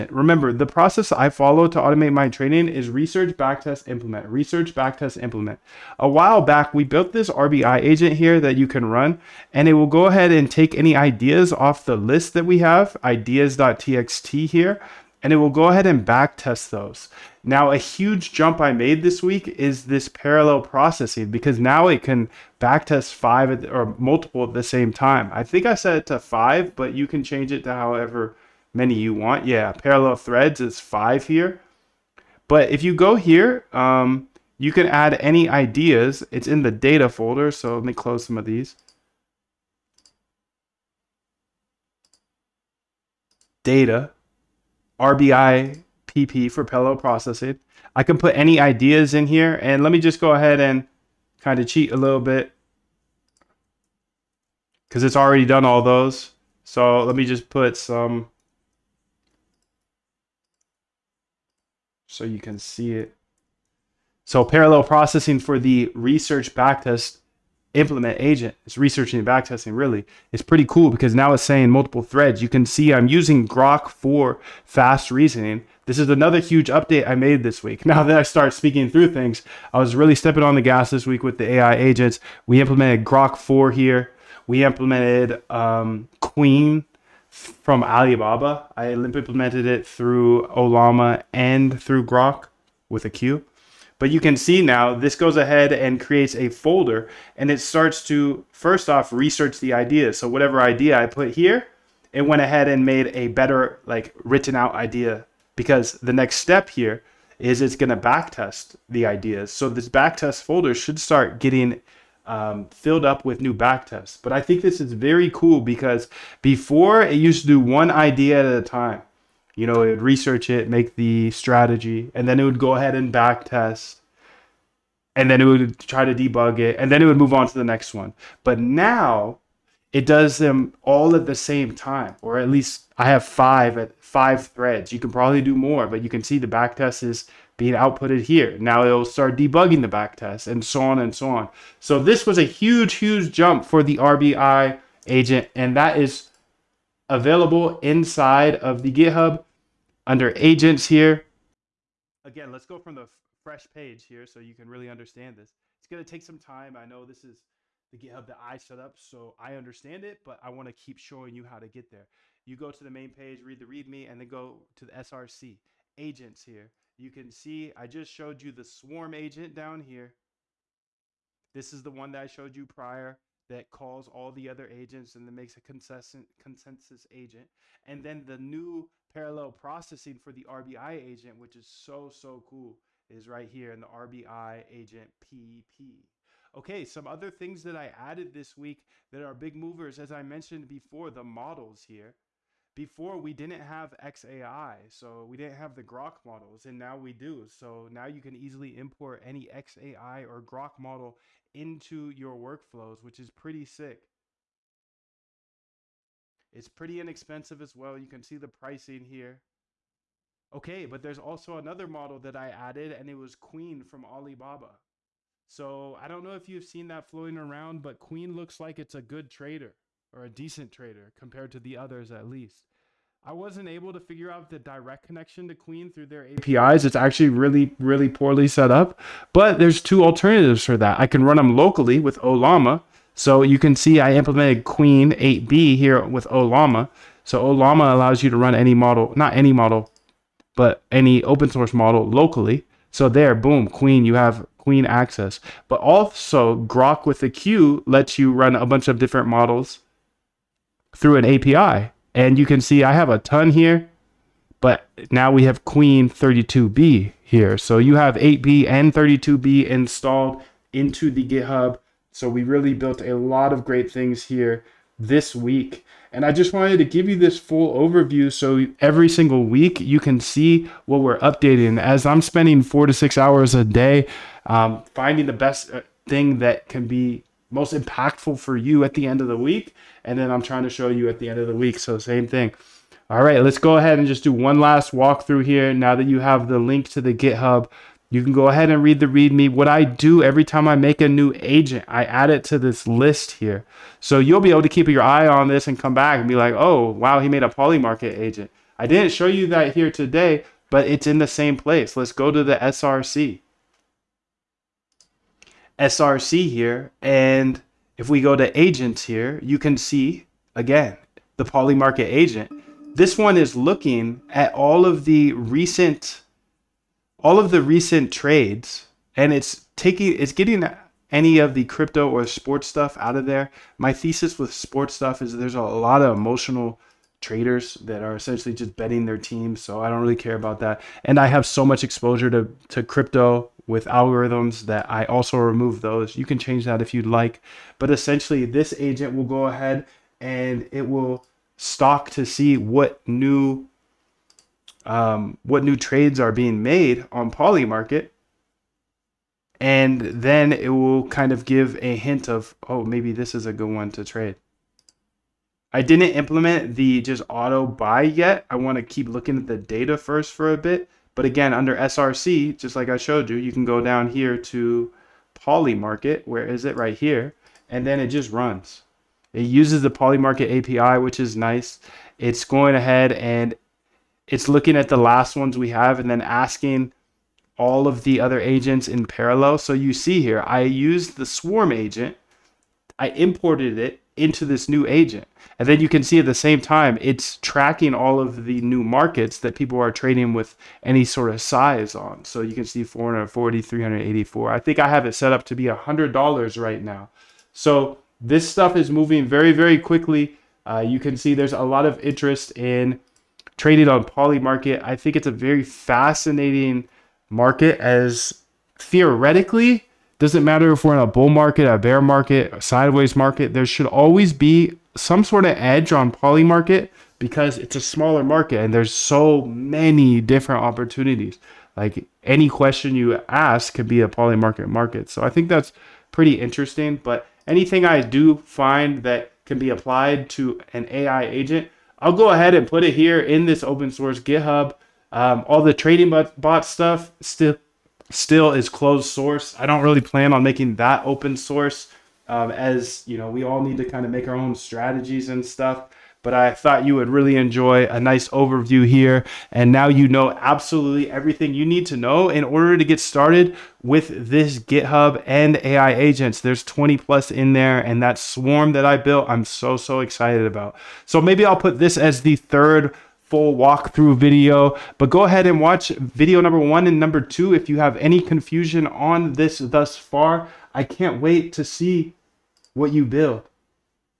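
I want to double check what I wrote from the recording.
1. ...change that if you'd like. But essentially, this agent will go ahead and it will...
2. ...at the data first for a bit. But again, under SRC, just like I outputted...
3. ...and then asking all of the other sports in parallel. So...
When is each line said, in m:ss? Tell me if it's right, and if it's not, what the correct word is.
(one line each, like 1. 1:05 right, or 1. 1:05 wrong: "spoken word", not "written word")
1. 5:36 right
2. 5:59 wrong: "showed", not "outputted"
3. 6:15 wrong: "agents", not "sports".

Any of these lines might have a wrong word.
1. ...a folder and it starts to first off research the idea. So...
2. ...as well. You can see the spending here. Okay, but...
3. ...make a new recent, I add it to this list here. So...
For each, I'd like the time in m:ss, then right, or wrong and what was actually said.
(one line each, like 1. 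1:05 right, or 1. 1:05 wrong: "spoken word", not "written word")
1. 1:36 right
2. 3:27 wrong: "pricing", not "spending"
3. 4:50 wrong: "agent", not "recent".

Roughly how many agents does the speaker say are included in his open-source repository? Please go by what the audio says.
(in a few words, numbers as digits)
20 plus.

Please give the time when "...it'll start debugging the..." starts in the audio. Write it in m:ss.
2:18.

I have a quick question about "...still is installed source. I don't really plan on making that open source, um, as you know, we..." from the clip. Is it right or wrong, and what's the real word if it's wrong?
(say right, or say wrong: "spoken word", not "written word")
wrong: "closed", not "installed".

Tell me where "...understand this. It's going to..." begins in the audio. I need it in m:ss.
2:34.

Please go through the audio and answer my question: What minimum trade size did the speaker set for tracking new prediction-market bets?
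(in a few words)
$100.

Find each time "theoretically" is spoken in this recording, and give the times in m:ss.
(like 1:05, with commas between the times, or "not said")
6:48.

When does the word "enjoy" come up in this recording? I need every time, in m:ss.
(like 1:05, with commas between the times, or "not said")
7:27.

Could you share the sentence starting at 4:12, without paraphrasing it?
And you can see I have a ton here, but now we have Qwen 32B here.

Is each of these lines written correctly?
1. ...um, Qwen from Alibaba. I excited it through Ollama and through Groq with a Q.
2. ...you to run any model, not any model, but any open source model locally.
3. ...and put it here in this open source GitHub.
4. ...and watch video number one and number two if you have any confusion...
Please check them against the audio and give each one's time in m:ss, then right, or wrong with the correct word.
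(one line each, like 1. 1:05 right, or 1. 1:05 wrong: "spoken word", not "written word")
1. 1:25 wrong: "implemented", not "excited"
2. 3:58 right
3. 7:12 right
4. 7:45 right.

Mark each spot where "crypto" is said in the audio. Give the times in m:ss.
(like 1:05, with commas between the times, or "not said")
5:21, 5:32.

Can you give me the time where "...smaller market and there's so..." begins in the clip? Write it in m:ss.
6:57.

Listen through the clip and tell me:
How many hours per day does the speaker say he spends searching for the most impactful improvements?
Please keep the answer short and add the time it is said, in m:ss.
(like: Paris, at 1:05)
4 to 6, at 4:32.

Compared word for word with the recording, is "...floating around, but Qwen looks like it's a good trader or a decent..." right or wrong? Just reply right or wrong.
right.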